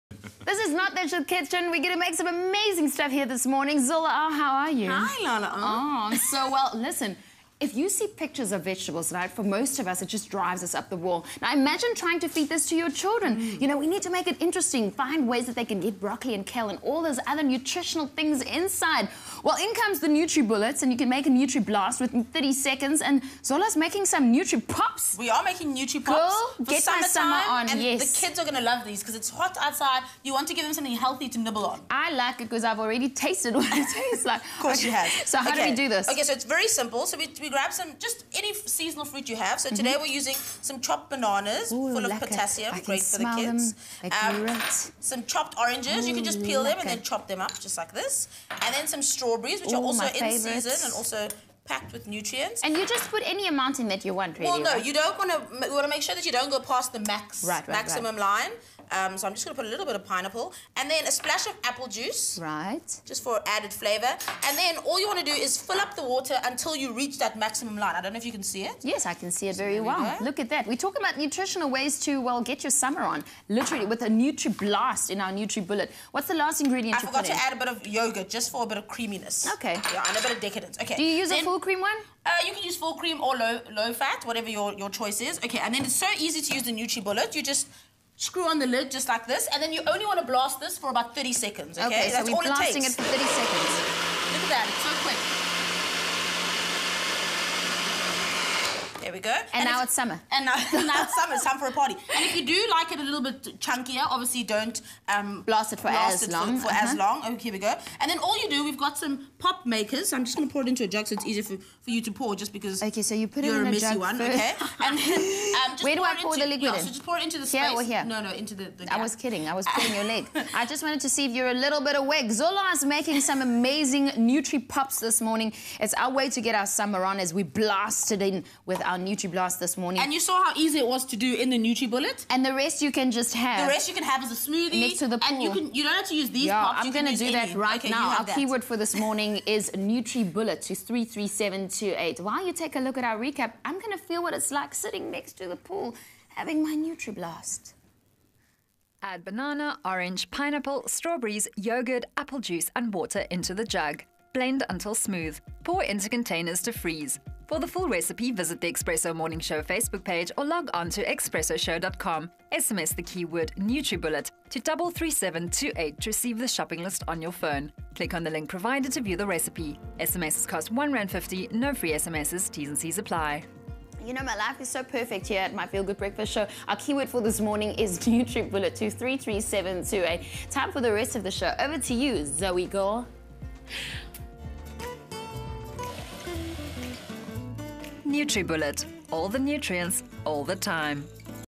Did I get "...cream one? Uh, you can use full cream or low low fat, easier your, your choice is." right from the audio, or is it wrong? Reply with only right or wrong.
wrong.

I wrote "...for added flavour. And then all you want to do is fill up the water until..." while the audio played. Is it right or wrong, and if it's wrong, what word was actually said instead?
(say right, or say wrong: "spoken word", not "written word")
right.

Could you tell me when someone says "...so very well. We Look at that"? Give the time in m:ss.
1:09.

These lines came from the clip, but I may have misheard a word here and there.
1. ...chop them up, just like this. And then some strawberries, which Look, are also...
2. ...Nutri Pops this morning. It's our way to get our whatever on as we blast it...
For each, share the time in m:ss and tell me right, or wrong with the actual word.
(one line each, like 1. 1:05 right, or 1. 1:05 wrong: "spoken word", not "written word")
1. 0:47 wrong: "Ooh", not "Look"
2. 2:04 wrong: "summer", not "whatever".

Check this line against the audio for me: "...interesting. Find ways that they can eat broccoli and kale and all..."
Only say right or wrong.
right.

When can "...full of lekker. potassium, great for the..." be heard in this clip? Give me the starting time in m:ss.
0:41.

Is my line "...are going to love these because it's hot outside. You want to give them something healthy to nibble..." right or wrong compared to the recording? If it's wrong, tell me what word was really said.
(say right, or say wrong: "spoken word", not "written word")
right.